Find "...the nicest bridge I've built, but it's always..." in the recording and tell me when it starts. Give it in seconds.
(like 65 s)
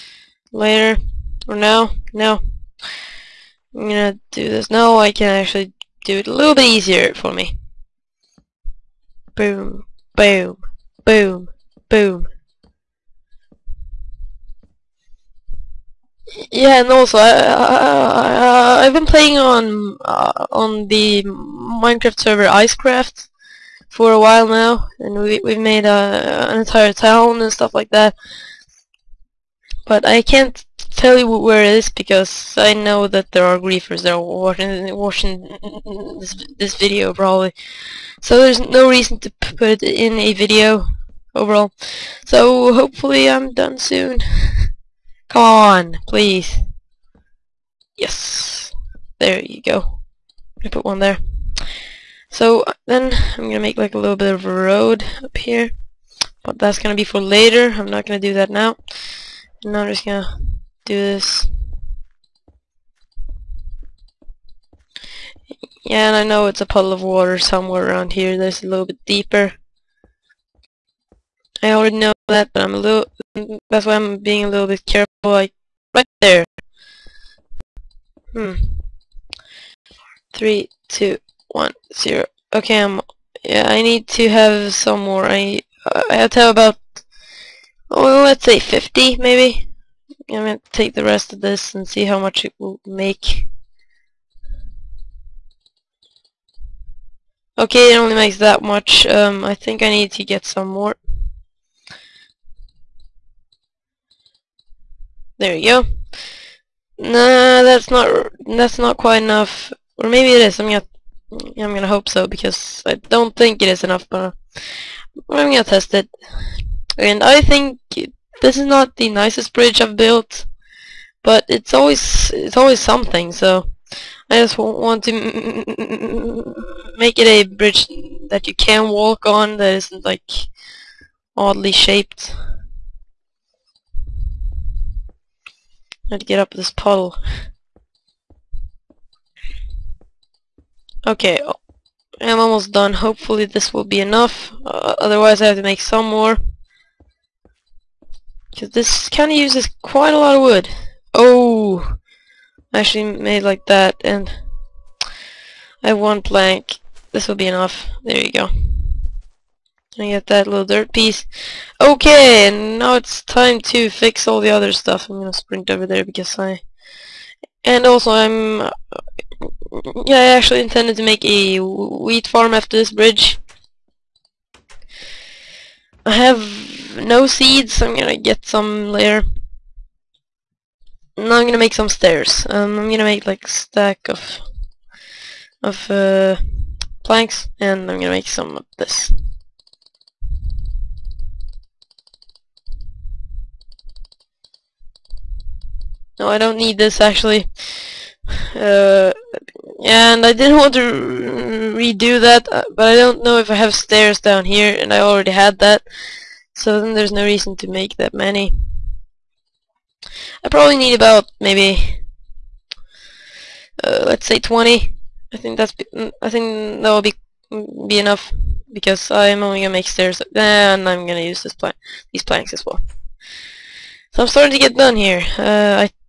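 118 s.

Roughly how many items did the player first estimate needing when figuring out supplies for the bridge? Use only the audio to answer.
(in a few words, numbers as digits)
50.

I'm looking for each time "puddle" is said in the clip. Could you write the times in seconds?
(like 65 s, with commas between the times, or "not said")
66 s, 136 s.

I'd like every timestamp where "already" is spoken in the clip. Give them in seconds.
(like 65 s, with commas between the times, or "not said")
71 s, 204 s.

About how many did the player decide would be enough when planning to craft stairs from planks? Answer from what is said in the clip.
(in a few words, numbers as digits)
20.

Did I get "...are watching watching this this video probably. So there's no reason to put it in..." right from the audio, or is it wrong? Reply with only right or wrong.
right.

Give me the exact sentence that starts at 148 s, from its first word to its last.
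Because this kind of uses quite a lot of wood.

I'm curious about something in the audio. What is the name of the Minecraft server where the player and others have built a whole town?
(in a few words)
Icecraft.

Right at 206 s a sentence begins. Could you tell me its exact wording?
So then there's no reason to make that many.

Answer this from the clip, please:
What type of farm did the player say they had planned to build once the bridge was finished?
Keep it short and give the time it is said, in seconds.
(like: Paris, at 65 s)
wheat farm, at 171 s.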